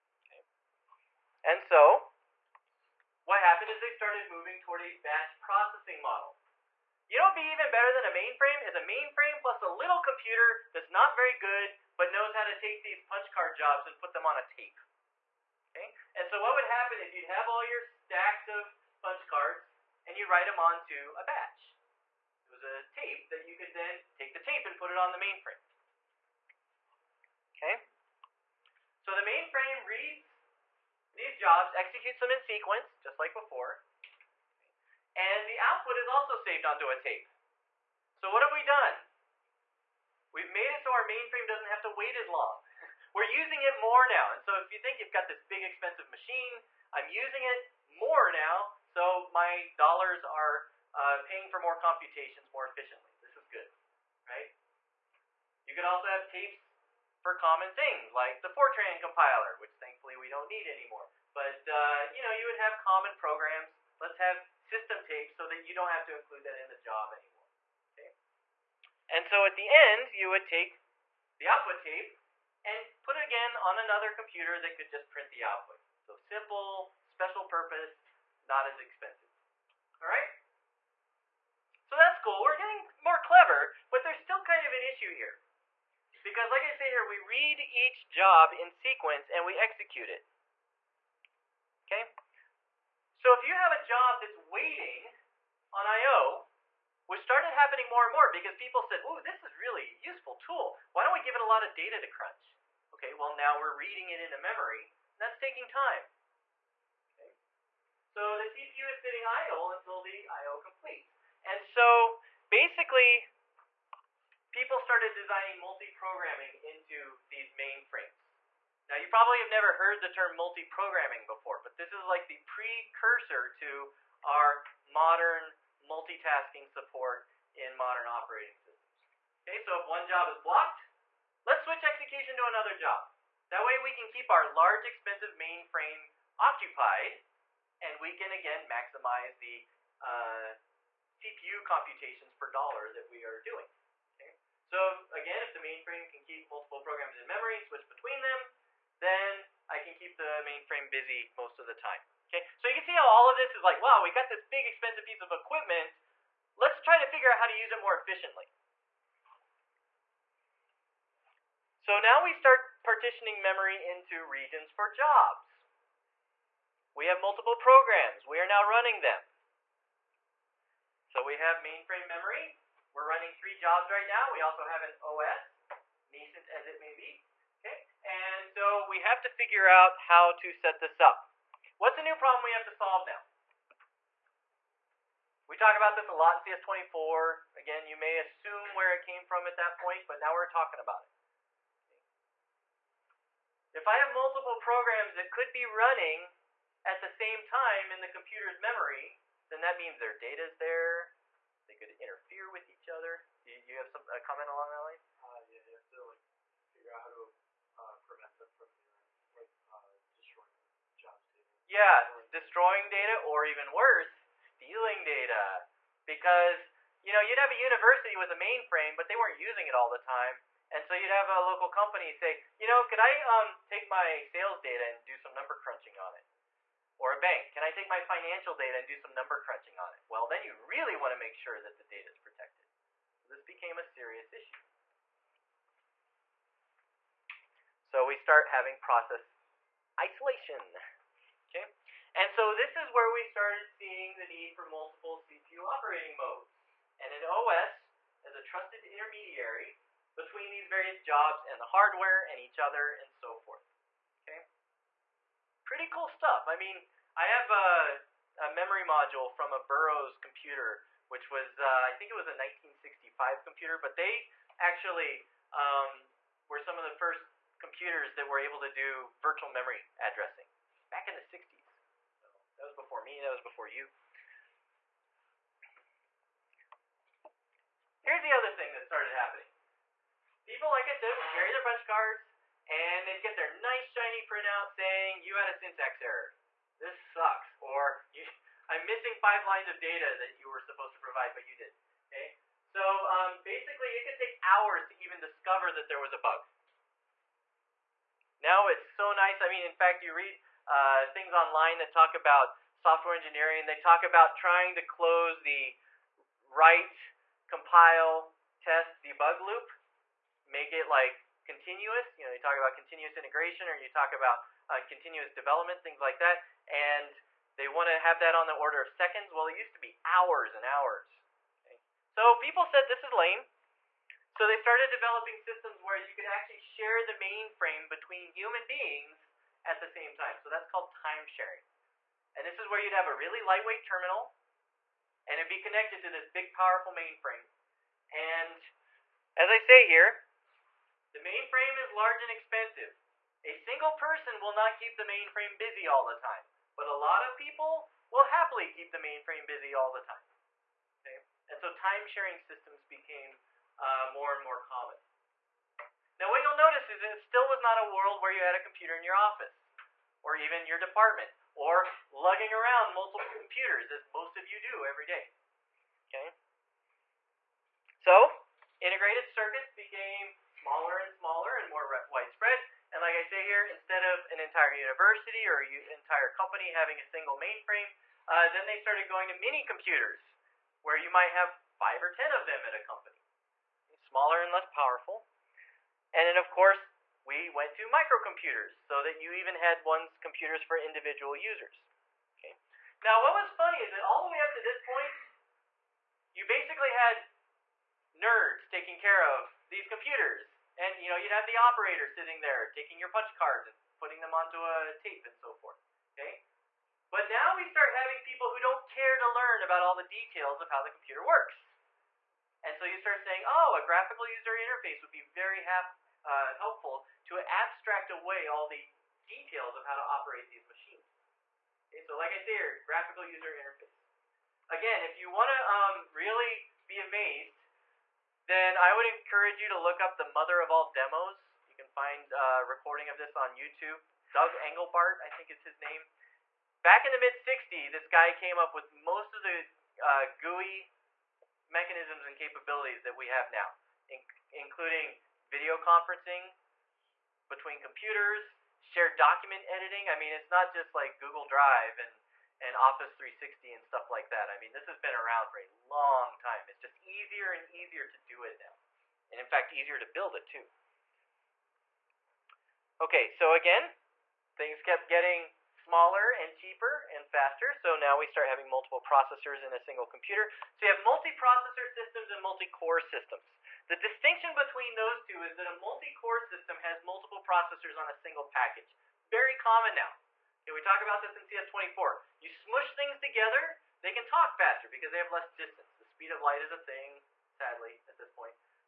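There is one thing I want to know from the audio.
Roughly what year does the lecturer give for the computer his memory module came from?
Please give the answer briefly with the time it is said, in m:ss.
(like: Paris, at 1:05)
1965, at 4:22.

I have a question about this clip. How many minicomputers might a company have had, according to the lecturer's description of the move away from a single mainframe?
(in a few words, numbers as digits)
5 or 10.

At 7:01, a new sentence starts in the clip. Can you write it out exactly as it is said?
Okay, so like I say here, graphical user interface.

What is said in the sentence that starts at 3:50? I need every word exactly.
Well, then you really want to make sure that the data is protected.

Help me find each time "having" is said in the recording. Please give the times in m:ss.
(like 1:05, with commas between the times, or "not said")
3:58, 6:16, 6:47, 7:48.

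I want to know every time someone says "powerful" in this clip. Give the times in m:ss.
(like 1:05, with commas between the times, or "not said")
5:36, 6:24.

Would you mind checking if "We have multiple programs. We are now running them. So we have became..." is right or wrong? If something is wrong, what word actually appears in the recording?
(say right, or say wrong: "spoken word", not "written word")
wrong: "mainframe", not "became".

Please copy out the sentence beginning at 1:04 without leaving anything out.
Let's have system tape so that you don't have to include that in the job anymore.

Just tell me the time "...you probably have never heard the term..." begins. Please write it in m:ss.
1:58.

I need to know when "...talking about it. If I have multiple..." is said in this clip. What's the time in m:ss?
3:10.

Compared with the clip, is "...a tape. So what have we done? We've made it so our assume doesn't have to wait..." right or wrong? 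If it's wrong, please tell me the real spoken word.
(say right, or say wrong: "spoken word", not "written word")
wrong: "mainframe", not "assume".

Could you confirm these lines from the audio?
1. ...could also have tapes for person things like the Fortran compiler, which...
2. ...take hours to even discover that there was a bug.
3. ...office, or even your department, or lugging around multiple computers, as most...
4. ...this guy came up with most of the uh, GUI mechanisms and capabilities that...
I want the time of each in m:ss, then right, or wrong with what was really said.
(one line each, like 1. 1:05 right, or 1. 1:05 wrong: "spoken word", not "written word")
1. 0:55 wrong: "common", not "person"
2. 4:54 right
3. 5:59 right
4. 7:17 right.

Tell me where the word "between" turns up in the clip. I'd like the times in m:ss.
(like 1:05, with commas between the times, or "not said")
2:27, 4:10, 5:27, 7:27, 7:54.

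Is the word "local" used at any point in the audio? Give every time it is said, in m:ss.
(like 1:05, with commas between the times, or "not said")
3:41.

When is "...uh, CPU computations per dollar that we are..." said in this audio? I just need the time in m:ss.
2:20.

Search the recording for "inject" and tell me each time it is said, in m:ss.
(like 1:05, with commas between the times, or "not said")
not said.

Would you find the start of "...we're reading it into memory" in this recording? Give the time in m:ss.
1:43.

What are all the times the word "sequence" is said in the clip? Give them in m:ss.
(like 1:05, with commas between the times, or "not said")
0:32, 1:28.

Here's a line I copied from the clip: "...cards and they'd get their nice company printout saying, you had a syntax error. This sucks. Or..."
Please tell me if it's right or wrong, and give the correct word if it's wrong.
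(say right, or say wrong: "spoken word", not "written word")
wrong: "shiny", not "company".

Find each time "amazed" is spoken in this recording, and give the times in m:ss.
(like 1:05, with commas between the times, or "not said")
7:06.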